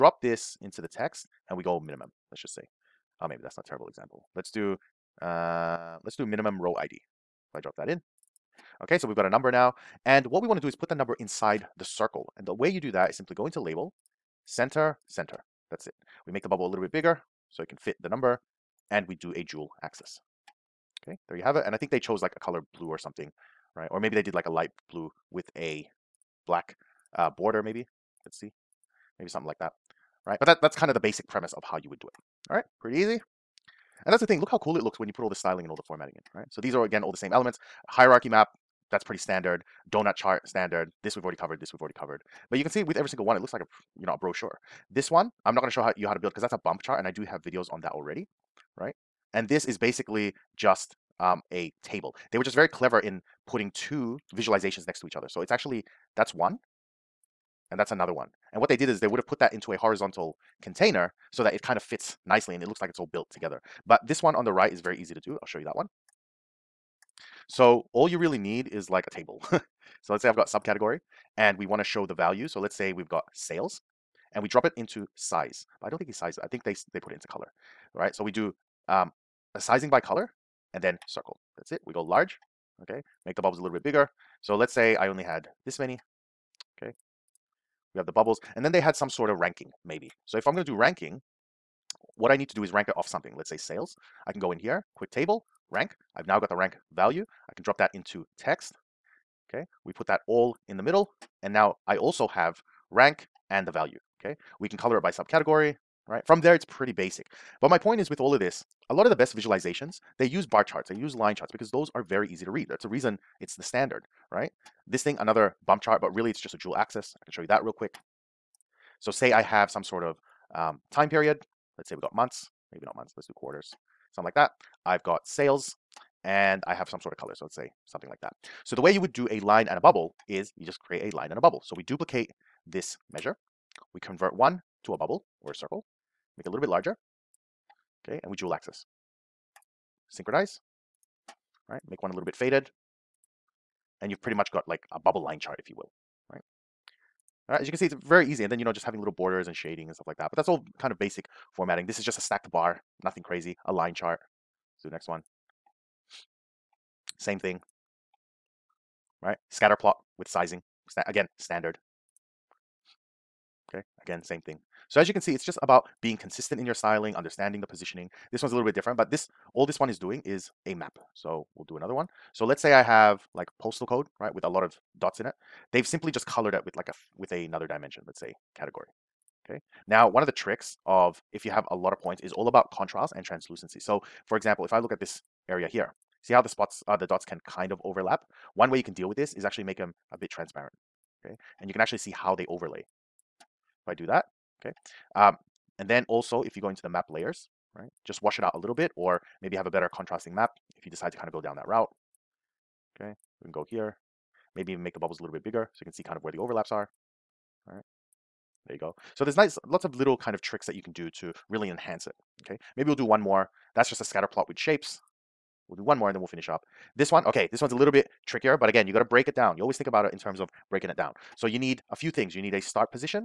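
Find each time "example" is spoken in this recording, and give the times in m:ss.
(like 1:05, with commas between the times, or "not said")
0:03, 3:04.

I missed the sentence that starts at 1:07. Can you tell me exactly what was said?
So all you really need is like a table.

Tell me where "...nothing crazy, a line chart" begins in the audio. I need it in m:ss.
2:33.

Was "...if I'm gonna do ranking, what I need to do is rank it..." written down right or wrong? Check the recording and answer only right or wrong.
right.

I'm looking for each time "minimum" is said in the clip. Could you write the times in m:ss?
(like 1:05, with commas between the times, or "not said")
0:01, 0:06.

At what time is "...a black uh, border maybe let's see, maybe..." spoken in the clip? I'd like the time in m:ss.
0:25.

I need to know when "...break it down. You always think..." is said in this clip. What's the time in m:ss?
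3:39.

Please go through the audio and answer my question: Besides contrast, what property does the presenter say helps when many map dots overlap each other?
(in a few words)
translucency.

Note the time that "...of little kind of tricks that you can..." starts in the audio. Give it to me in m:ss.
3:29.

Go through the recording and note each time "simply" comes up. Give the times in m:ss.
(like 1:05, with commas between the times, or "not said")
0:13, 2:55.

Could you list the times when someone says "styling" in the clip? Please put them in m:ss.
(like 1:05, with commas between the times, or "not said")
0:35, 2:46.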